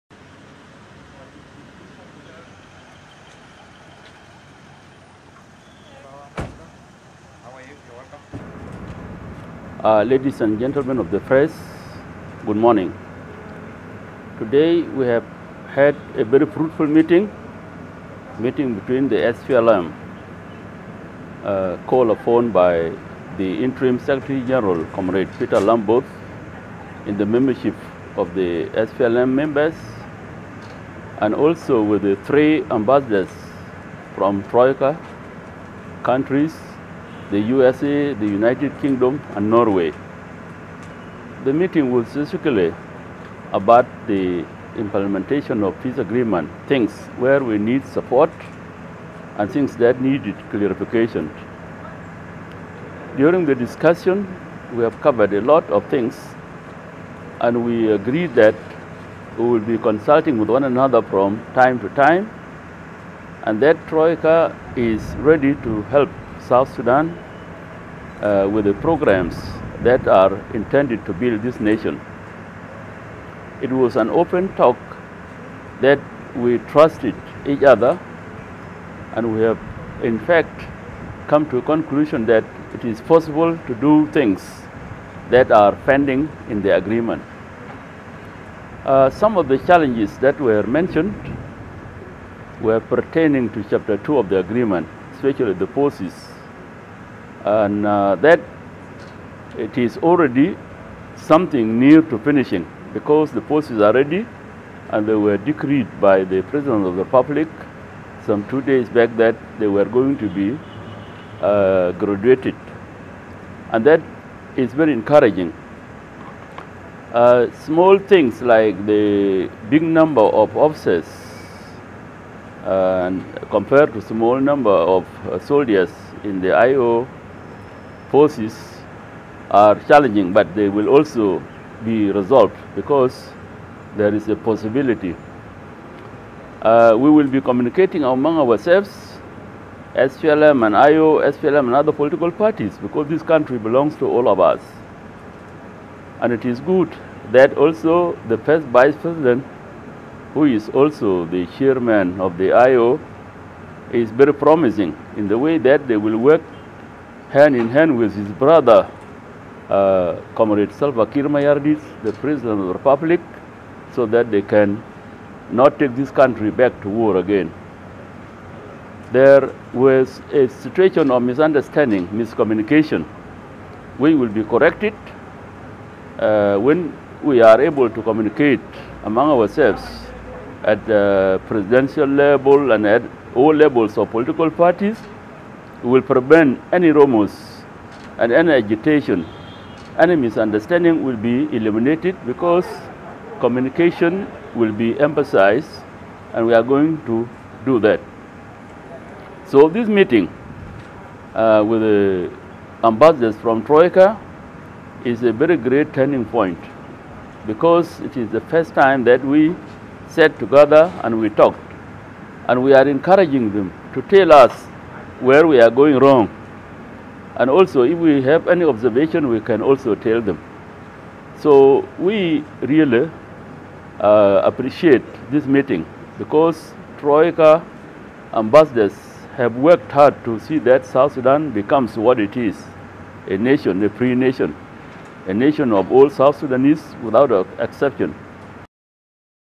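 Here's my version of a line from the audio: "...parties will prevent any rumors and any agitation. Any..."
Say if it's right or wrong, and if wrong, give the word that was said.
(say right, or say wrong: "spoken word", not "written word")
right.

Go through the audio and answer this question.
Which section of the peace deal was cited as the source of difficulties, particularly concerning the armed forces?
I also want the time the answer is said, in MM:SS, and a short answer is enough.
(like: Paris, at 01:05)
Chapter 2, at 01:33.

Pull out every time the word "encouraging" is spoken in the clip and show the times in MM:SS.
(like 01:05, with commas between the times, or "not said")
01:54, 03:32.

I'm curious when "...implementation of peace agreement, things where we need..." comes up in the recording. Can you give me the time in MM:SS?
00:44.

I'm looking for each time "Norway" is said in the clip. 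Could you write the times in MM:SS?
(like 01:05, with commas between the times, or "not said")
00:39.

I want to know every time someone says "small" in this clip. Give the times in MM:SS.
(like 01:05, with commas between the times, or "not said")
01:57, 02:04.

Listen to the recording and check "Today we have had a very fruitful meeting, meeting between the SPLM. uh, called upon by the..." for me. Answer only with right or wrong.
right.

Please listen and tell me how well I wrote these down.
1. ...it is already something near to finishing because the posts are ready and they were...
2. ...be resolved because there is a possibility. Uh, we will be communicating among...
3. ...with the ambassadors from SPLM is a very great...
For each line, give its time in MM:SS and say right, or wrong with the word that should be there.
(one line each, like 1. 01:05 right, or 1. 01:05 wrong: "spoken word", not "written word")
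1. 01:39 right
2. 02:11 right
3. 03:21 wrong: "Troika", not "SPLM".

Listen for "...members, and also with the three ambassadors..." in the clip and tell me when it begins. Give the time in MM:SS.
00:29.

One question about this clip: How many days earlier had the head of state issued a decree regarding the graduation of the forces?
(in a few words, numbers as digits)
2.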